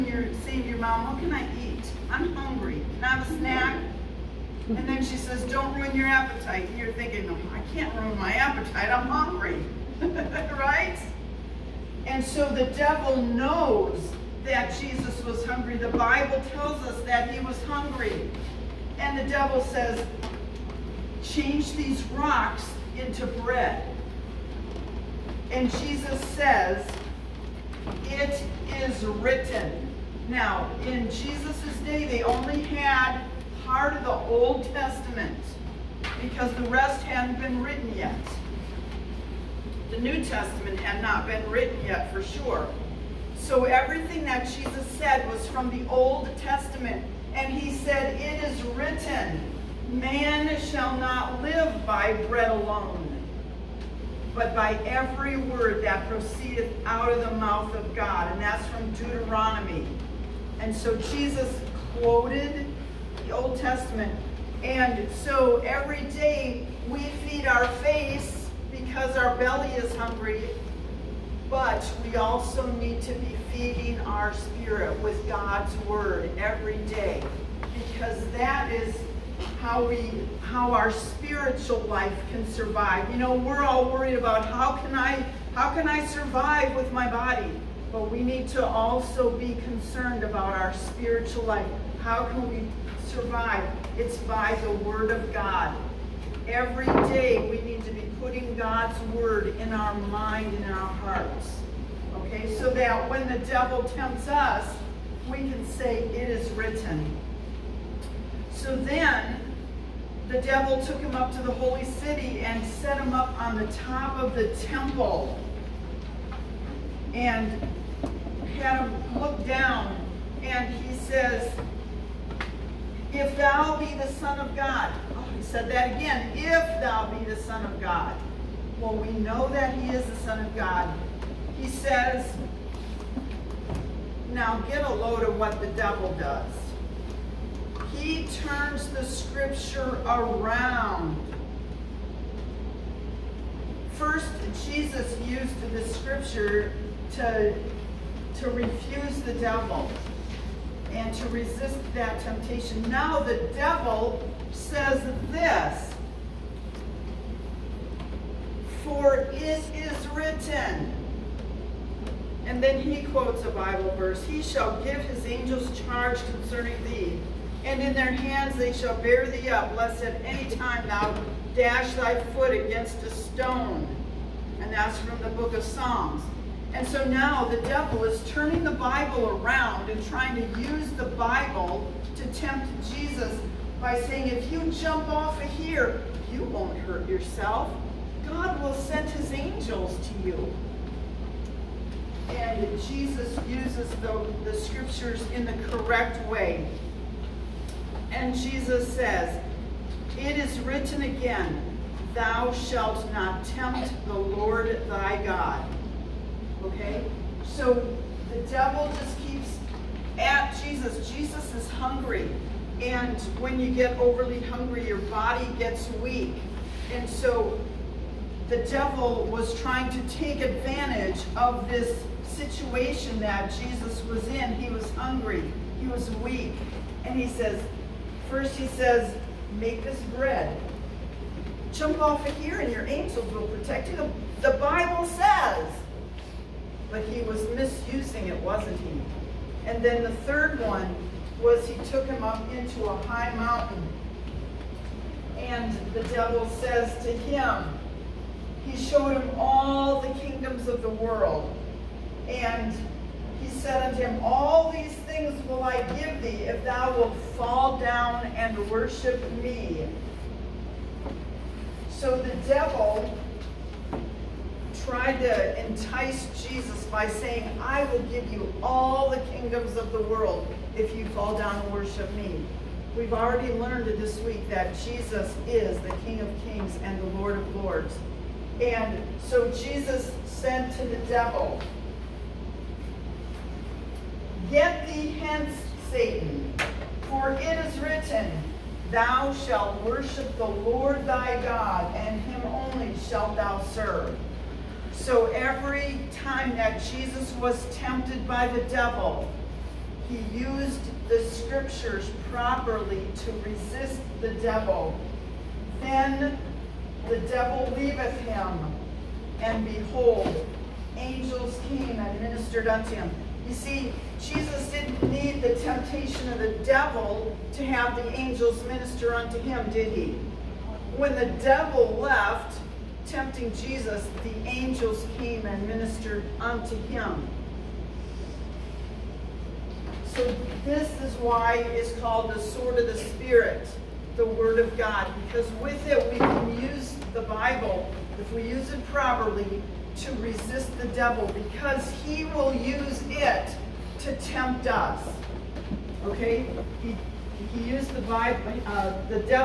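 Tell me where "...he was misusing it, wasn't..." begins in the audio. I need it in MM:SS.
03:57.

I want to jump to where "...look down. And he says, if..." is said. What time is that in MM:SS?
01:59.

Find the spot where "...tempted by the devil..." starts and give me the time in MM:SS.
04:57.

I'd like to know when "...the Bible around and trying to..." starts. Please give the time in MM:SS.
02:58.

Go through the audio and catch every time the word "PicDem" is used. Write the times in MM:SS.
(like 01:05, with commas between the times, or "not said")
not said.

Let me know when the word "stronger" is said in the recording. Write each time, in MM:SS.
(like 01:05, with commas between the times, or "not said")
not said.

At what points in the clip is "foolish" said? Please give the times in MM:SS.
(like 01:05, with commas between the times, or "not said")
not said.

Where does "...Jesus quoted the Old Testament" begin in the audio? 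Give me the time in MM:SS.
01:00.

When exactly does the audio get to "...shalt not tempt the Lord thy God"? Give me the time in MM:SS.
03:22.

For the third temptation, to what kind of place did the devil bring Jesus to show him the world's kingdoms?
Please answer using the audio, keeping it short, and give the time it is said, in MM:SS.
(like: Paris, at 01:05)
A high mountain, at 04:02.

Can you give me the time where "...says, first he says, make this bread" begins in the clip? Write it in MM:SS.
03:47.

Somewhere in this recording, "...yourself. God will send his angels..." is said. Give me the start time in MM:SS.
03:07.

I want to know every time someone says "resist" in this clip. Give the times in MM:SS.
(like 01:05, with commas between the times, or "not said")
02:31, 05:03, 05:40.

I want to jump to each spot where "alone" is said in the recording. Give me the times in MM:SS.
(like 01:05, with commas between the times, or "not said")
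00:52.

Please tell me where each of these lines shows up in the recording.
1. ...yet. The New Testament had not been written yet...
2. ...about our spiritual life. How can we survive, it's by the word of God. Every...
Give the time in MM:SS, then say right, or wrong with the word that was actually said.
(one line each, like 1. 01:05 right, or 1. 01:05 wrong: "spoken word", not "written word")
1. 00:37 right
2. 01:30 right.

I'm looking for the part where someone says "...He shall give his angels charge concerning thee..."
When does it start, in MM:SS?
02:44.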